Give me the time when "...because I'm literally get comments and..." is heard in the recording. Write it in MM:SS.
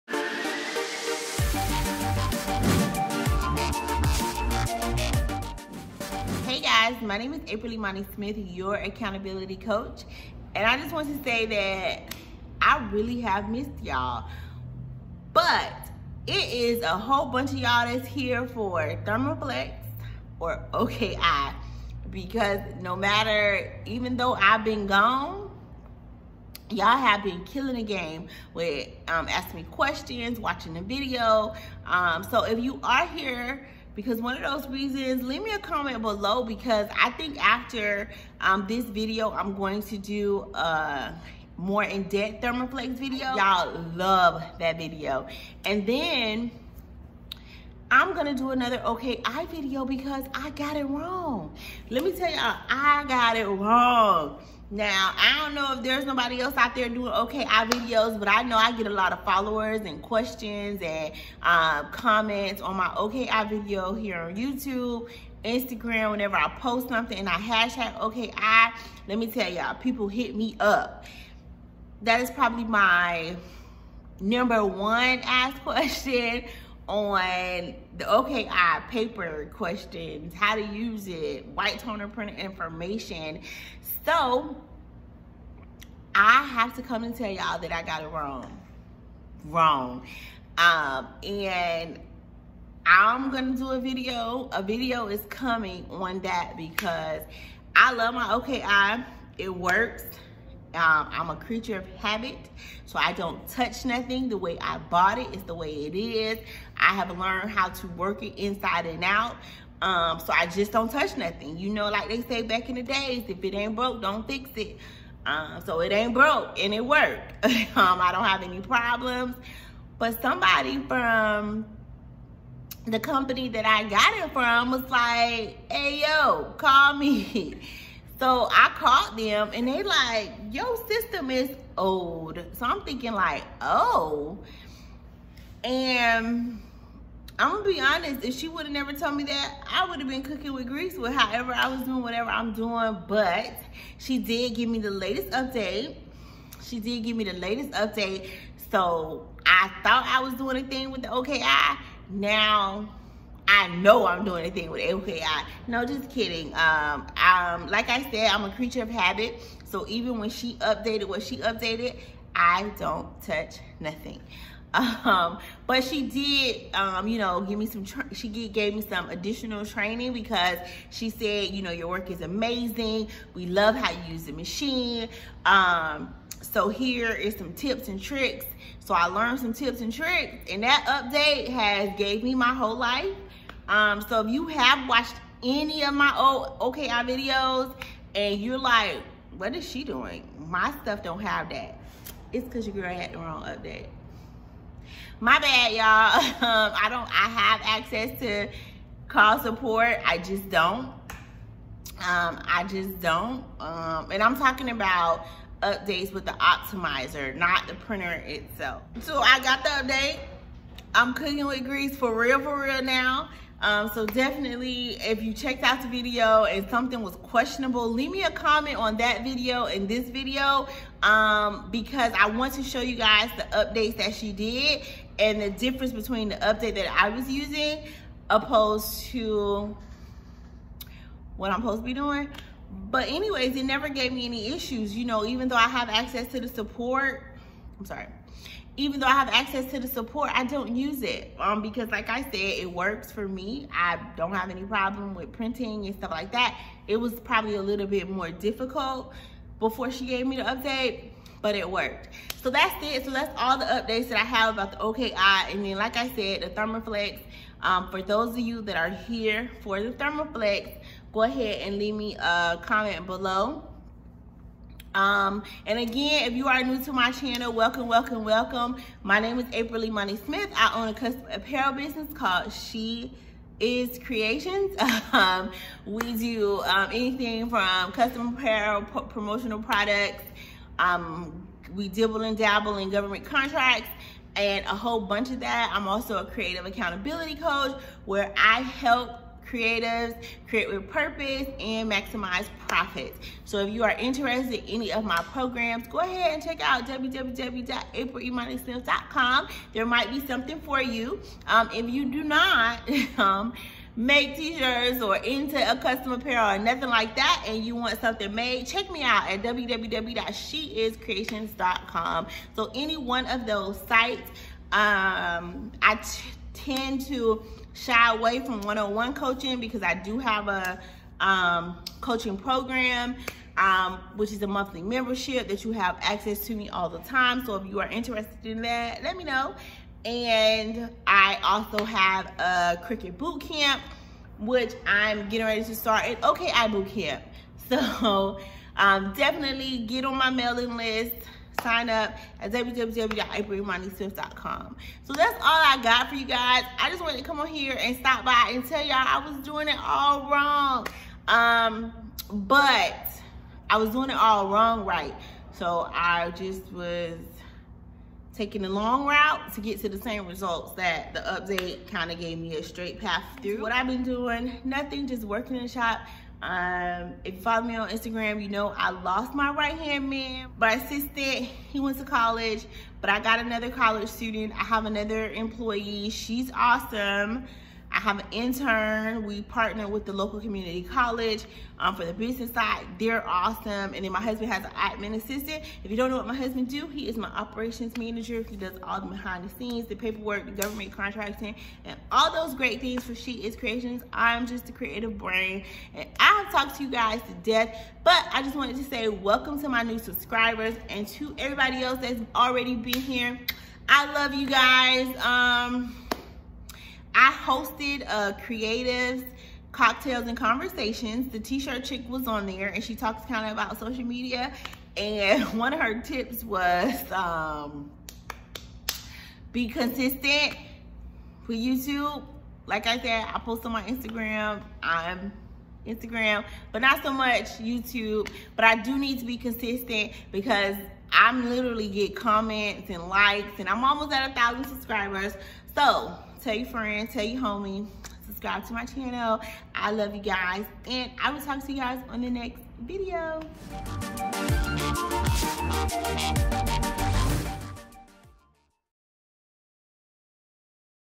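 07:10.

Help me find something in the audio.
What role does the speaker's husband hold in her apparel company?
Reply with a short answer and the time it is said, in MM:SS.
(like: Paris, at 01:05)
Operations manager, at 06:27.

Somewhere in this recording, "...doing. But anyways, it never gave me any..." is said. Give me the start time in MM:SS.
03:51.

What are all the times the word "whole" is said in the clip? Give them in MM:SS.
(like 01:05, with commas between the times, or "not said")
00:16, 03:02, 04:44.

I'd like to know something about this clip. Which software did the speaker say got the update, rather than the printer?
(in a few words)
The optimizer.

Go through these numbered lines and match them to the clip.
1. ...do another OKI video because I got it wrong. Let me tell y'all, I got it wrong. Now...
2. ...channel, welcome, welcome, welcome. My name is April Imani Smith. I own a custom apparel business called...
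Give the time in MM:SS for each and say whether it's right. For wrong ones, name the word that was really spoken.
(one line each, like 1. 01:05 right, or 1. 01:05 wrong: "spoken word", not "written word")
1. 00:48 right
2. 04:27 right.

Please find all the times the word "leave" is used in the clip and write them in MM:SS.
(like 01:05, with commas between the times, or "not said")
00:35, 03:37, 04:21.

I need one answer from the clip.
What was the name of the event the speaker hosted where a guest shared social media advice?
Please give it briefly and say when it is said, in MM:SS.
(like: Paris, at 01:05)
Creative Cocktails and Conversations, at 06:48.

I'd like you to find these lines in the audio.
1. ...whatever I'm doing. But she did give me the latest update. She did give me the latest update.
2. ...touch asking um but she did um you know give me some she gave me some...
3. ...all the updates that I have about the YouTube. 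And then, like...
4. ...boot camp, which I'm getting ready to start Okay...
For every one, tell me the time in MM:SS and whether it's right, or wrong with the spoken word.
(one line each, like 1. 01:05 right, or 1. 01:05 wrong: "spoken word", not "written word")
1. 02:22 right
2. 02:43 wrong: "nothing", not "asking"
3. 04:13 wrong: "OKI", not "YouTube"
4. 05:33 right.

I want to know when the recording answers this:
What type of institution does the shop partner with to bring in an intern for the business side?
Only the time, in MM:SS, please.
06:20.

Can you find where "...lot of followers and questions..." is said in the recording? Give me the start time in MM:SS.
00:58.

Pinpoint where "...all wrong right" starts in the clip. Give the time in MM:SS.
05:54.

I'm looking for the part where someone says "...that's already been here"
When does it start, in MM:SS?
06:41.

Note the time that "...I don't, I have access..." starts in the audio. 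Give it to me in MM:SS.
03:16.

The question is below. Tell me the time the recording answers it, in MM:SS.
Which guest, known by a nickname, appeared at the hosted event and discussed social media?
06:51.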